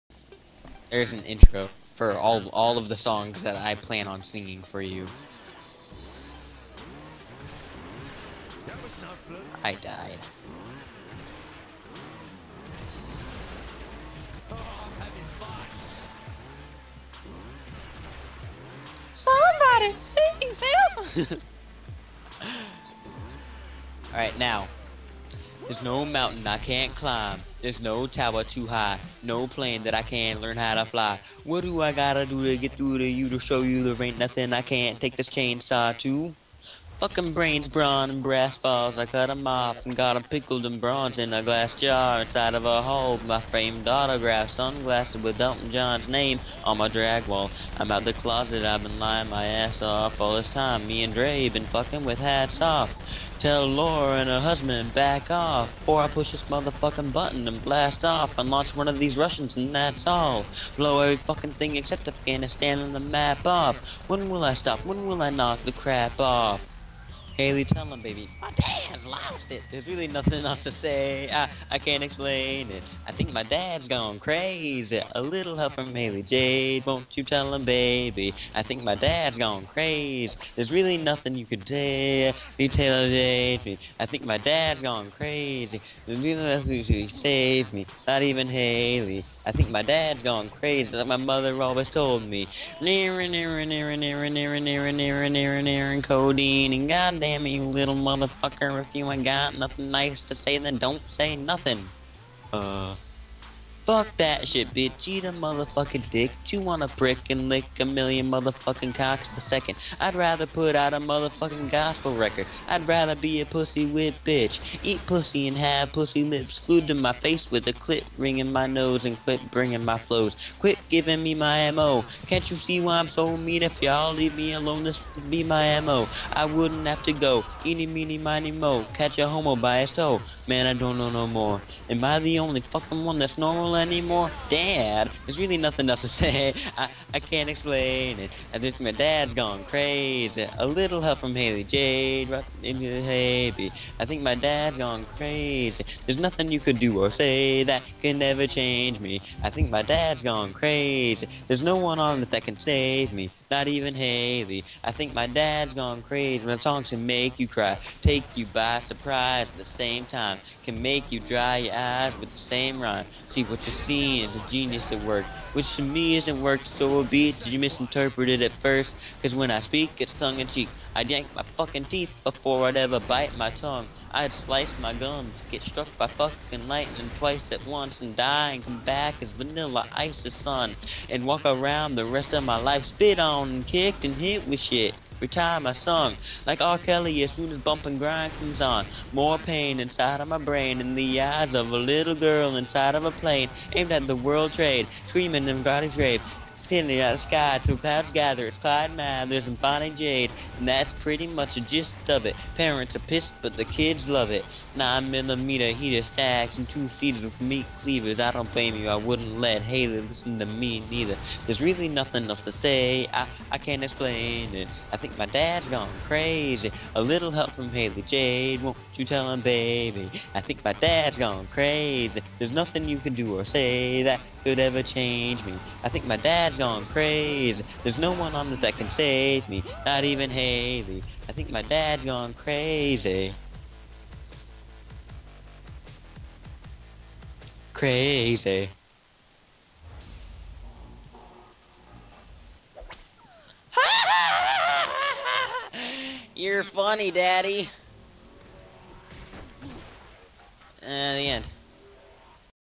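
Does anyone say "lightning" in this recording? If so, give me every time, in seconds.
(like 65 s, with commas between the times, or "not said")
176 s.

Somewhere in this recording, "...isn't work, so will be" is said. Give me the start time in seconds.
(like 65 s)
166 s.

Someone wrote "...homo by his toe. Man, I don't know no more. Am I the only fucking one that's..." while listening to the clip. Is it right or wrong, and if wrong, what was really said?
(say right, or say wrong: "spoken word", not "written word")
right.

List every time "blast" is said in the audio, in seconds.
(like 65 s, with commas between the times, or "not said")
57 s.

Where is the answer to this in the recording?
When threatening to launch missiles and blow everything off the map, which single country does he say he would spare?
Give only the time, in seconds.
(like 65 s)
62 s.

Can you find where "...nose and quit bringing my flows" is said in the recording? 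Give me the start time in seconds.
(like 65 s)
118 s.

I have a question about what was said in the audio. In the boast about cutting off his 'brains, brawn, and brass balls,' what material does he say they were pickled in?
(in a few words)
bronze.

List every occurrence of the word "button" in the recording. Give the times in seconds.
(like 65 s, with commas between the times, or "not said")
57 s.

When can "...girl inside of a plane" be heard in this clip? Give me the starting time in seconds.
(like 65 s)
192 s.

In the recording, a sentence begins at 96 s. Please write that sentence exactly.
And goddamn you little motherfucker, if you ain't got nothing nice to say, then don't say nothing.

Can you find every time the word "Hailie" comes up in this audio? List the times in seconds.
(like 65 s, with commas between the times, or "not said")
67 s, 75 s, 88 s, 141 s, 209 s, 217 s, 230 s.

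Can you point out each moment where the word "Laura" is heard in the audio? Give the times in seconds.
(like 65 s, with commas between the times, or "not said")
53 s.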